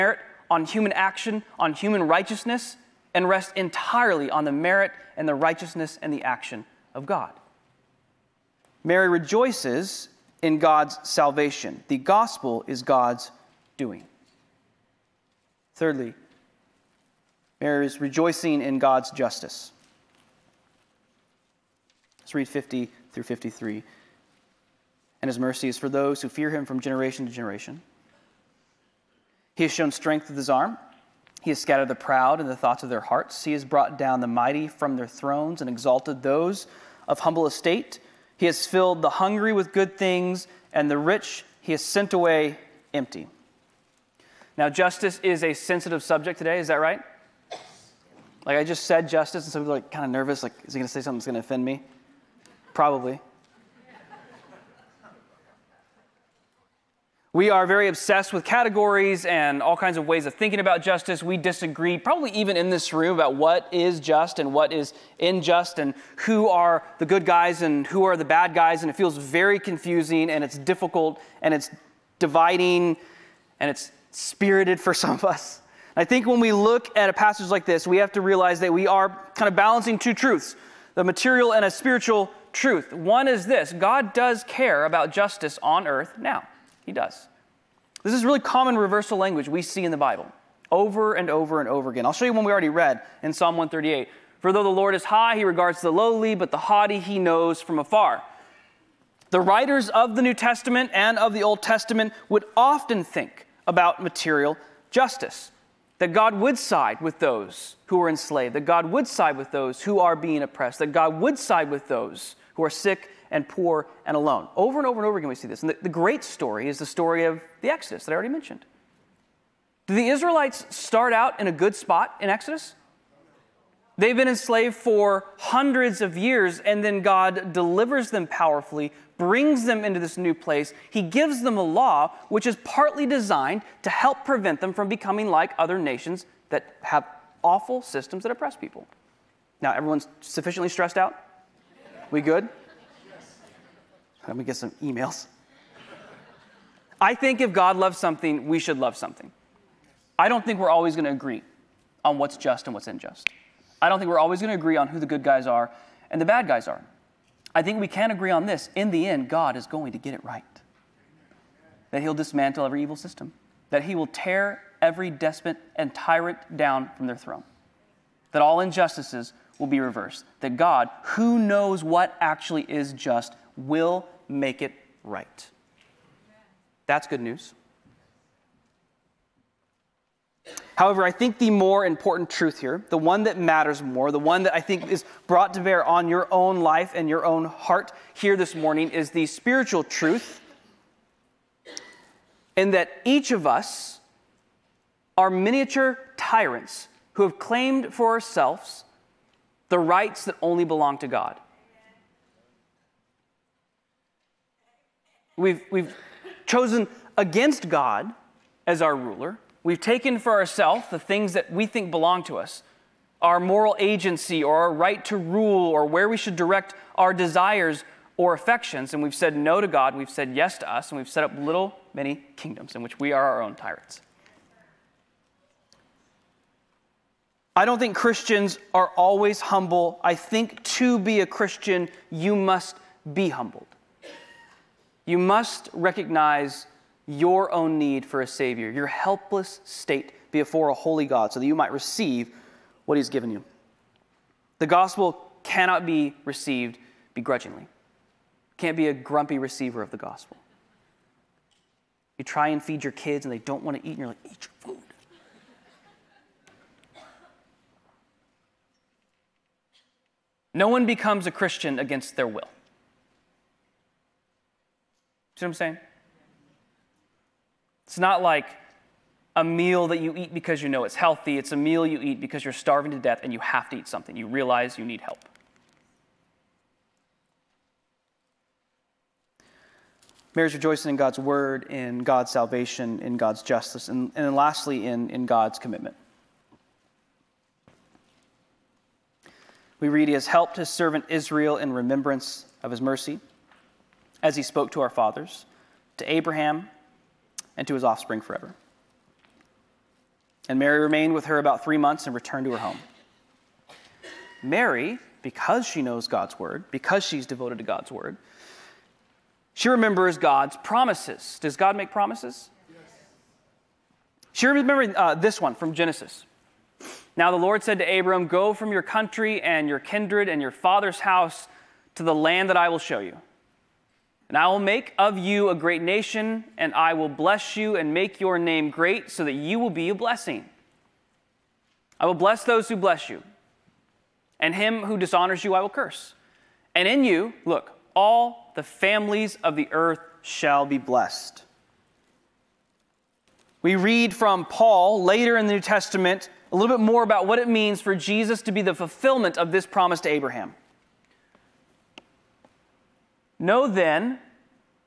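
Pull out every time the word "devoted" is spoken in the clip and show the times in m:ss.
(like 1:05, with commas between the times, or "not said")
5:07.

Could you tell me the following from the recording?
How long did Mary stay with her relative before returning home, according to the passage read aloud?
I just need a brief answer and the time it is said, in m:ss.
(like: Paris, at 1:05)
3 months, at 5:01.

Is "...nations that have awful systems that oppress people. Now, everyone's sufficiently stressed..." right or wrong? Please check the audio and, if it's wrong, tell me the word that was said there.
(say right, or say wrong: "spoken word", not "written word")
right.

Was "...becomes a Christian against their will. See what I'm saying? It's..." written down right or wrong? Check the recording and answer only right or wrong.
right.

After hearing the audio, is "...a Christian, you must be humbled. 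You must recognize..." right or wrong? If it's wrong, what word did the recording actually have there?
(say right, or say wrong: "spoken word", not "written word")
right.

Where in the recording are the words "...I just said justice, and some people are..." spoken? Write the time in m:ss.
0:48.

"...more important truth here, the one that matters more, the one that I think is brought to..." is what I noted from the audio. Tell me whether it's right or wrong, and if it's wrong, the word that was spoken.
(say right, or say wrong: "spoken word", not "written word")
right.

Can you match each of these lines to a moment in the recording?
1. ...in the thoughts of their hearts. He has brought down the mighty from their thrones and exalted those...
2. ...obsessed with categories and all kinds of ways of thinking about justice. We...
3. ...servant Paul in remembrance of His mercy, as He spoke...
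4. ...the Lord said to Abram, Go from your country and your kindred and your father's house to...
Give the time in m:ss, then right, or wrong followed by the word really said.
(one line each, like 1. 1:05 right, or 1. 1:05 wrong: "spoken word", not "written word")
1. 0:32 right
2. 0:57 right
3. 4:50 wrong: "Israel", not "Paul"
4. 5:17 right.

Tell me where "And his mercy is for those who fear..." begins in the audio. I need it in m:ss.
0:25.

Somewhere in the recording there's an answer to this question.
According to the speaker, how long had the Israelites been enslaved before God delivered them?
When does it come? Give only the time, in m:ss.
2:05.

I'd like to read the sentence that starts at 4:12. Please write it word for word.
You try and feed your kids and they don't want to eat, and you're like, eat your food.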